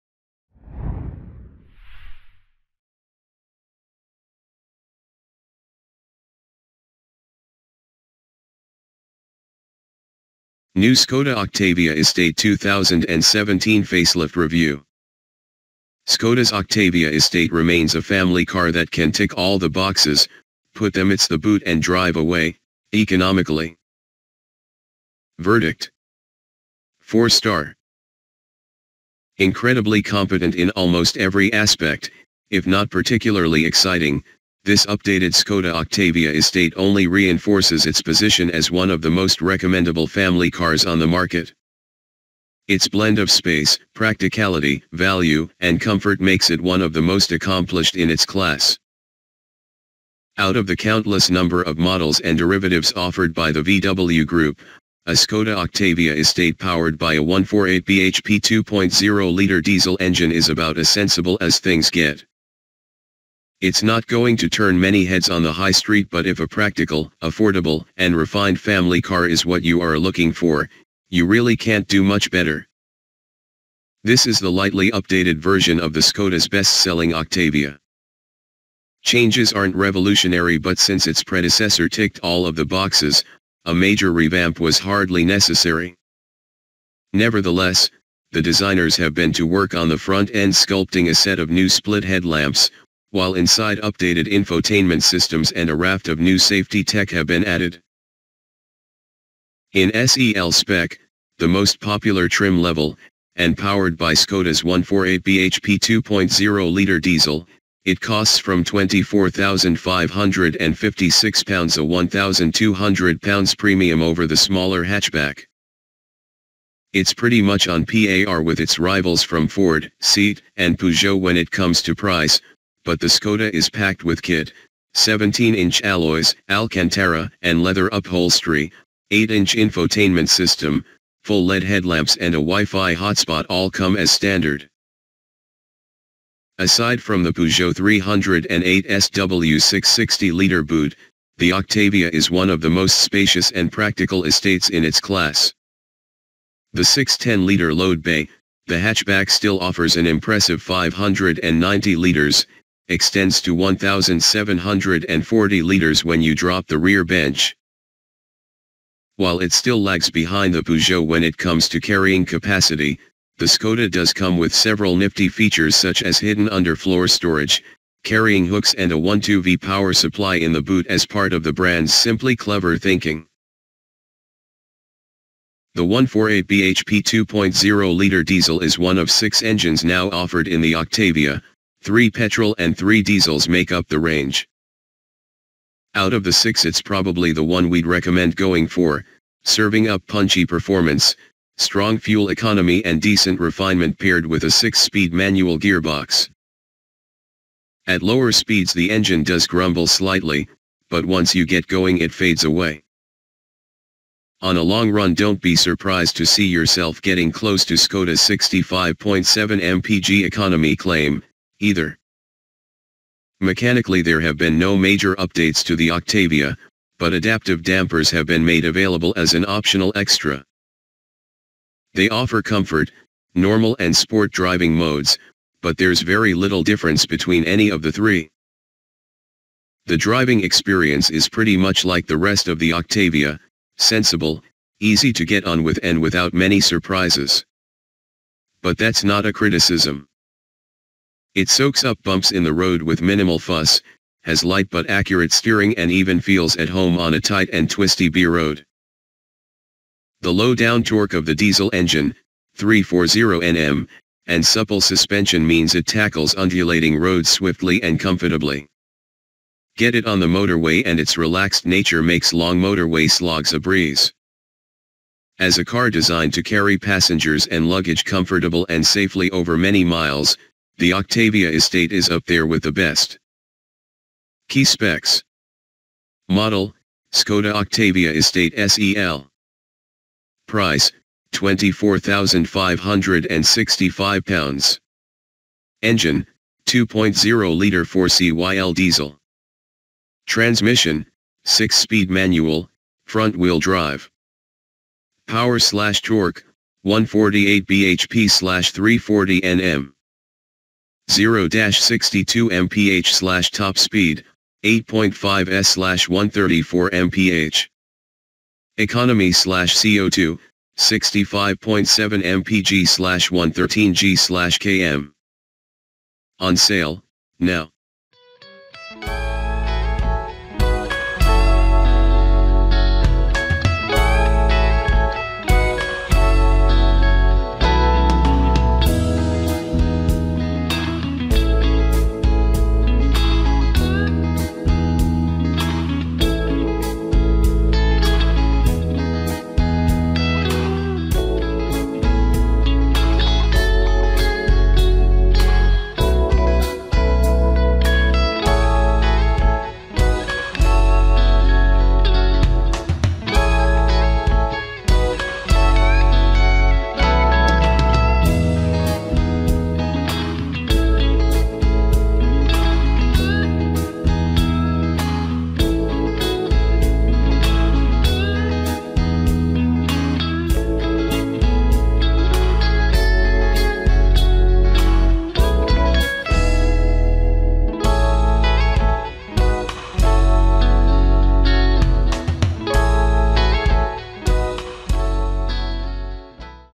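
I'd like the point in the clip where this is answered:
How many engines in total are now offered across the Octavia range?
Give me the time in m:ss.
2:59.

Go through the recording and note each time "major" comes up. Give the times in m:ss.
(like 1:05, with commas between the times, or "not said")
1:23, 3:34.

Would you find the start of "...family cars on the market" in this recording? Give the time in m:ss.
0:40.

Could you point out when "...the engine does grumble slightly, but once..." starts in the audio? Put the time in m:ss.
3:18.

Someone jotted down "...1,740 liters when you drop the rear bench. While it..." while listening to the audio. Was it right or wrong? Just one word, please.
right.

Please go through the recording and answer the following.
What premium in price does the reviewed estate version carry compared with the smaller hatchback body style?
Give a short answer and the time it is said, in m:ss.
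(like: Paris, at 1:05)
£1,200, at 1:51.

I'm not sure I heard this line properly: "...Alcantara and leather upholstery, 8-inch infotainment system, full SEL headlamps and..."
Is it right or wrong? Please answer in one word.
wrong.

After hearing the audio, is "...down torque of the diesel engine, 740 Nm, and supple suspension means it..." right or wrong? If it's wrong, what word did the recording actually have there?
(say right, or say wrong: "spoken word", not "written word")
wrong: "340", not "740".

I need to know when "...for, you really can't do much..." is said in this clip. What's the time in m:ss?
1:10.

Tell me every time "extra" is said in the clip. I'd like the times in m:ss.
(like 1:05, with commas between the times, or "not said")
3:39.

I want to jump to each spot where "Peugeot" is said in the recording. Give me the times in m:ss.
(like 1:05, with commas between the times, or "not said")
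2:00, 2:17, 2:40.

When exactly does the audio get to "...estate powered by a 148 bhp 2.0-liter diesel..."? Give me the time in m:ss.
0:56.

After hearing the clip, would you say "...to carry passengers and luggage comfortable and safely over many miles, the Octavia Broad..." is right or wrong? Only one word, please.
wrong.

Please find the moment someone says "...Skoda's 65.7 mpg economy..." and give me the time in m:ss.
3:27.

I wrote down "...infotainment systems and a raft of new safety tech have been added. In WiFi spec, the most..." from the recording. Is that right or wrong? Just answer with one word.
wrong.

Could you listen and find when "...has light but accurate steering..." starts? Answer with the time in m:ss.
4:04.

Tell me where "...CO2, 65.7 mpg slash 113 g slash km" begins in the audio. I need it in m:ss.
5:09.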